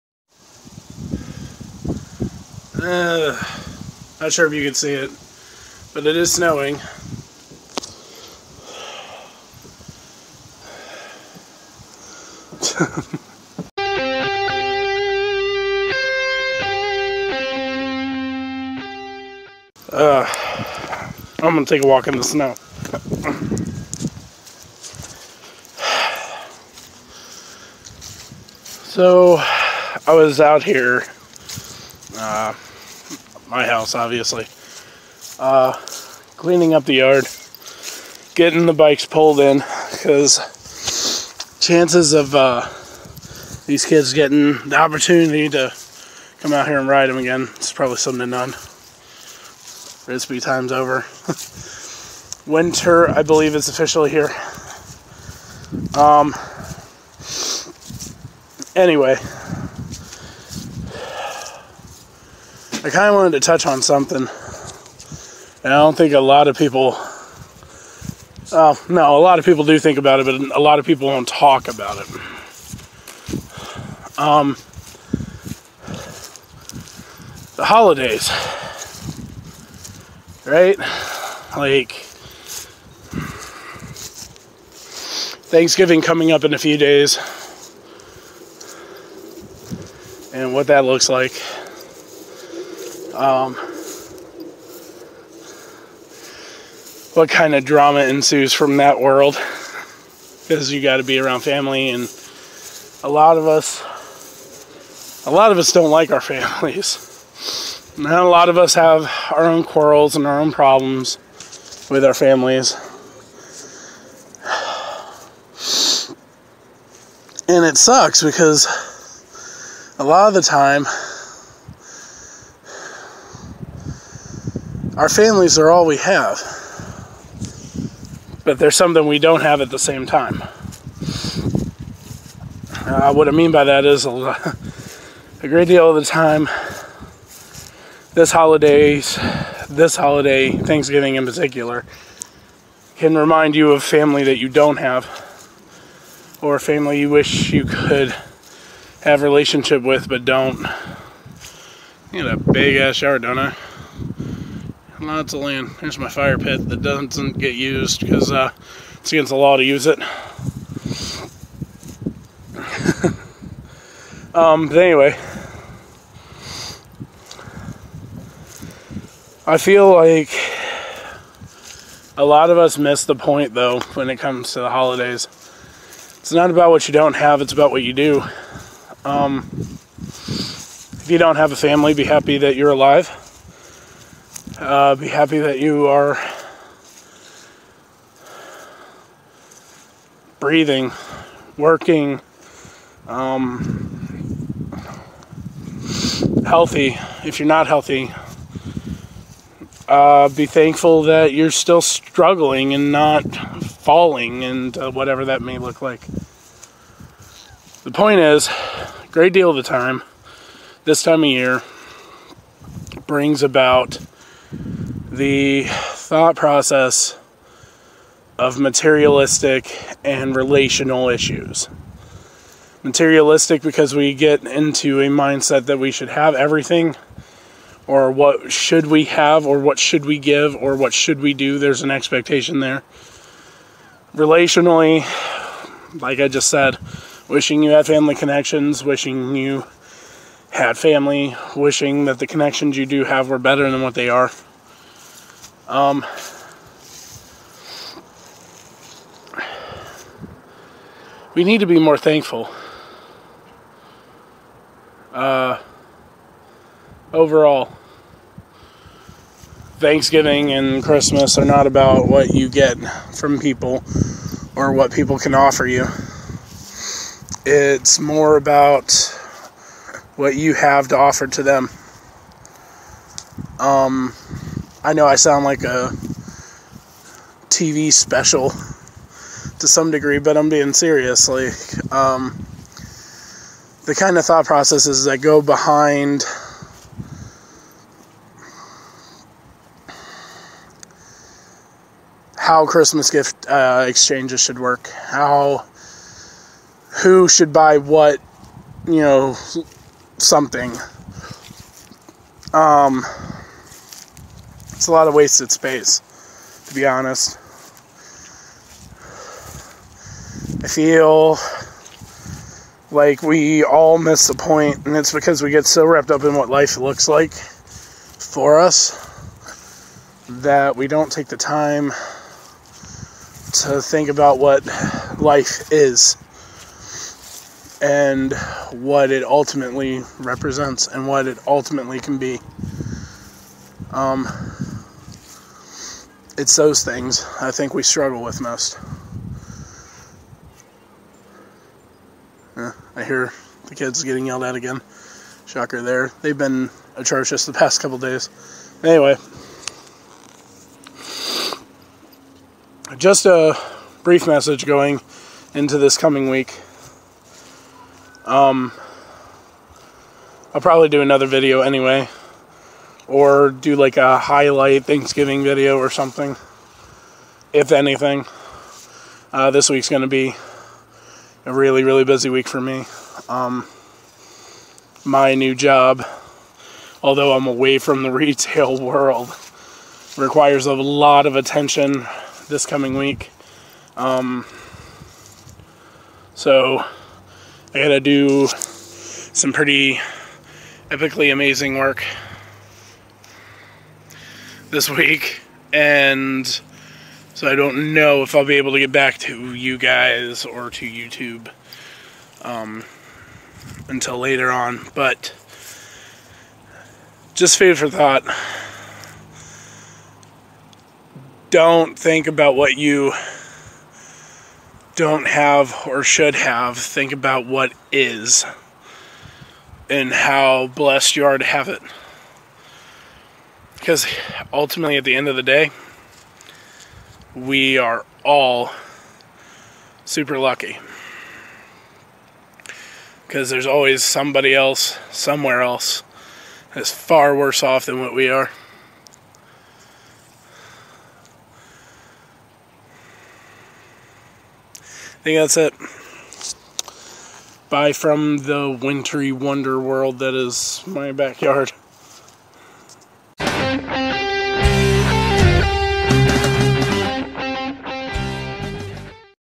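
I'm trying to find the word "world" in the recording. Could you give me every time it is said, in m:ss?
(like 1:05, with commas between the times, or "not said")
1:38, 6:18, 7:29.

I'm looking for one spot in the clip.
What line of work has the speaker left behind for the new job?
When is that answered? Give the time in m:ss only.
6:18.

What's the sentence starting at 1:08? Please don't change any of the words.
Uh, no, a lot of people do think about it, but a lot of people don't talk about it.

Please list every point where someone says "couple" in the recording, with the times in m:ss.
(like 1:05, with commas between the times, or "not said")
5:47.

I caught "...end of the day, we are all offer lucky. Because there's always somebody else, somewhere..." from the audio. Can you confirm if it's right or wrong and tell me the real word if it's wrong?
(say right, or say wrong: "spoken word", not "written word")
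wrong: "super", not "offer".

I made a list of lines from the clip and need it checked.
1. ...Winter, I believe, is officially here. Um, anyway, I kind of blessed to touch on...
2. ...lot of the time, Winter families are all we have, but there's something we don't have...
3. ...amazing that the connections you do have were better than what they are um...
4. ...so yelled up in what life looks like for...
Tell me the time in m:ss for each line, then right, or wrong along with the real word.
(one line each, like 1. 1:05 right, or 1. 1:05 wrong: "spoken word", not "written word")
1. 0:52 wrong: "wanted", not "blessed"
2. 2:00 wrong: "Our", not "Winter"
3. 4:01 wrong: "wishing", not "amazing"
4. 5:15 wrong: "wrapped", not "yelled".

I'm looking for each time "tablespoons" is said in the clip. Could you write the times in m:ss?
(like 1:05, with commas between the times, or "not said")
not said.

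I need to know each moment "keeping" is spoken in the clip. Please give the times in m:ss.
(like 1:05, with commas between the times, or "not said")
not said.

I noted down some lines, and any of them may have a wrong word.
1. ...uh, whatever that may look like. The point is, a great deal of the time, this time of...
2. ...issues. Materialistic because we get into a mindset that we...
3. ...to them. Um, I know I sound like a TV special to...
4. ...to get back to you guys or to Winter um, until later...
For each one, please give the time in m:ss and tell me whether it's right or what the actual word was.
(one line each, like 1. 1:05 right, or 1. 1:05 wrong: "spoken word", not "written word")
1. 3:24 right
2. 3:41 right
3. 4:31 right
4. 6:38 wrong: "YouTube", not "Winter".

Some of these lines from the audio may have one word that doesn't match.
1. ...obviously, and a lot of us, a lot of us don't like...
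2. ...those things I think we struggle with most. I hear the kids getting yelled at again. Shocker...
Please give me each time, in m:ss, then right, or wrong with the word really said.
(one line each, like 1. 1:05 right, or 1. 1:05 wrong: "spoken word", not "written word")
1. 1:41 wrong: "family", not "obviously"
2. 5:36 right.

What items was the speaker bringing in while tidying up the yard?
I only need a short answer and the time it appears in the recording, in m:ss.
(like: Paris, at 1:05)
Bikes, at 0:38.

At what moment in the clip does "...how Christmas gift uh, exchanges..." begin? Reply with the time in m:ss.
4:52.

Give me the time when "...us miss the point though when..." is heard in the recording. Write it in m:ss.
2:52.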